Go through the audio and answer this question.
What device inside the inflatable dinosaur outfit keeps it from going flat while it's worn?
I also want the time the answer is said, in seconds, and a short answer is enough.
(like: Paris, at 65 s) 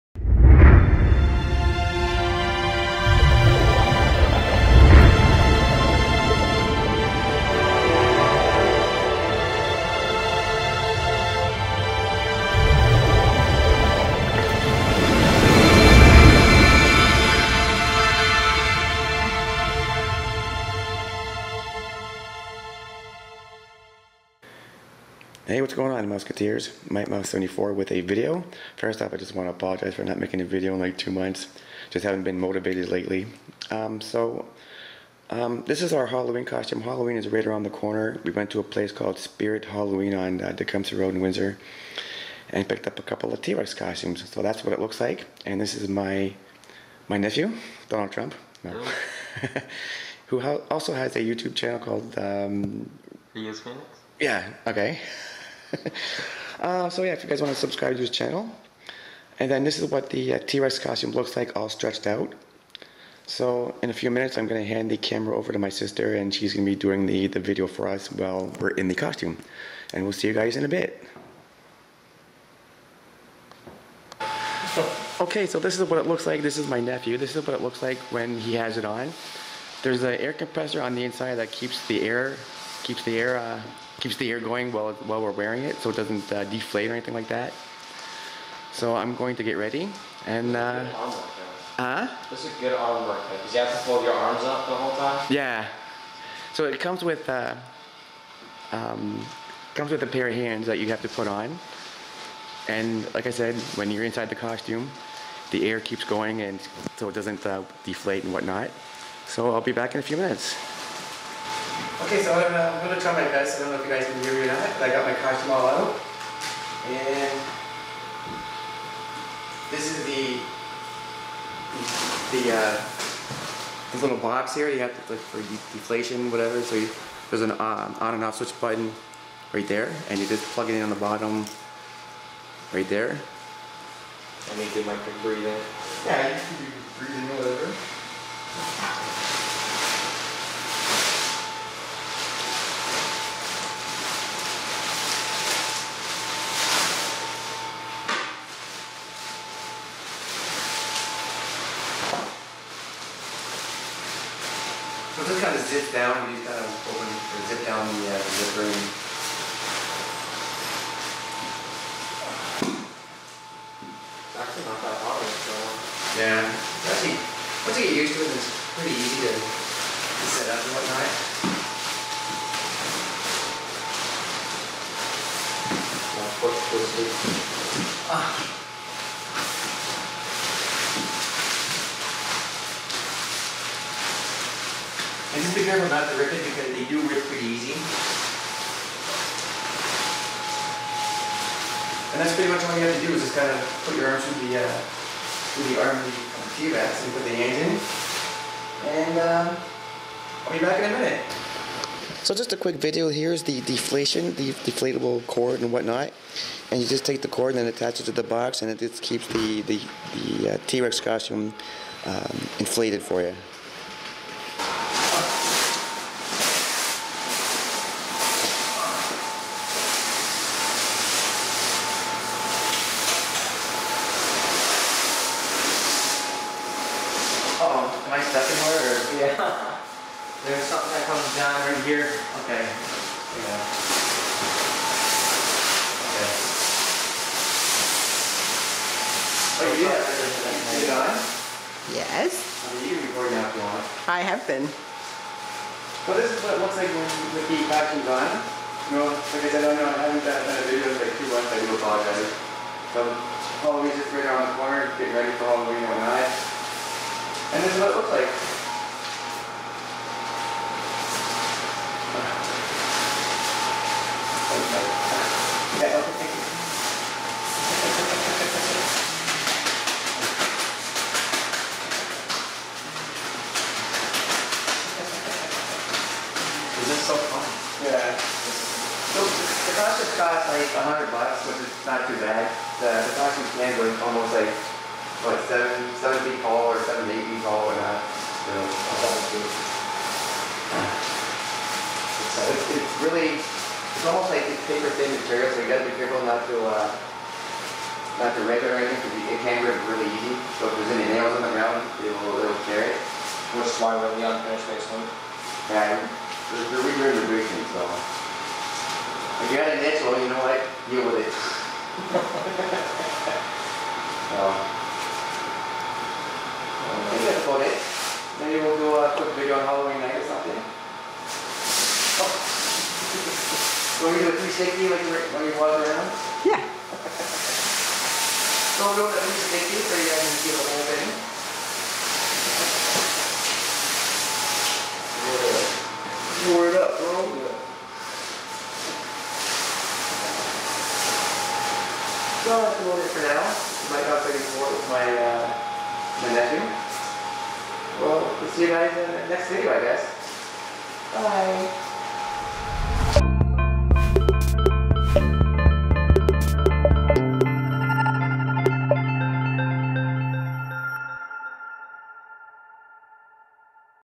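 air compressor, at 80 s.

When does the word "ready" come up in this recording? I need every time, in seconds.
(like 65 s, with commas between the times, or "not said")
89 s, 255 s.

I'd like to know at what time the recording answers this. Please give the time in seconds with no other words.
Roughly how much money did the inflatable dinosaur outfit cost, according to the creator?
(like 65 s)
280 s.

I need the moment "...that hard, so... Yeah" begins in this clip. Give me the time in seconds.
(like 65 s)
164 s.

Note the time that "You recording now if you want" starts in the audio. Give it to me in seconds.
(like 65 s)
242 s.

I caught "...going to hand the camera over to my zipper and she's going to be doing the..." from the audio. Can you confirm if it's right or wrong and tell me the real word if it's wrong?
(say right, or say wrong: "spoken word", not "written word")
wrong: "sister", not "zipper".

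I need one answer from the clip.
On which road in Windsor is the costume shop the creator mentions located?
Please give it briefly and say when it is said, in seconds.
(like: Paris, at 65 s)
Tecumseh Road, at 40 s.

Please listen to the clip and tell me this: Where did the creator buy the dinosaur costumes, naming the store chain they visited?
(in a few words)
Spirit Halloween.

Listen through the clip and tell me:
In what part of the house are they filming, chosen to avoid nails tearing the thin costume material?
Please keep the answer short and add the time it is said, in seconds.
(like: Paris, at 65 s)
unfinished basement, at 304 s.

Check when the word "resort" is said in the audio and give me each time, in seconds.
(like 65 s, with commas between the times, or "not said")
not said.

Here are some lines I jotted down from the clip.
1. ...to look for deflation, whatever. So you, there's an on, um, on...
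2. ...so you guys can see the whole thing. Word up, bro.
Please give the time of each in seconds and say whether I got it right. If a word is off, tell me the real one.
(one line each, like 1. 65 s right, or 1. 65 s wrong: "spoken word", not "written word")
1. 124 s right
2. 329 s right.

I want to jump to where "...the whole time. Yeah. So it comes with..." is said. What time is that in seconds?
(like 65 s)
94 s.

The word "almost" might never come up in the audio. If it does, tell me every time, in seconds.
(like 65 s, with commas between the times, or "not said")
284 s, 294 s.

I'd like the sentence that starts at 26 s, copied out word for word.
Might Mouse 74 with a video.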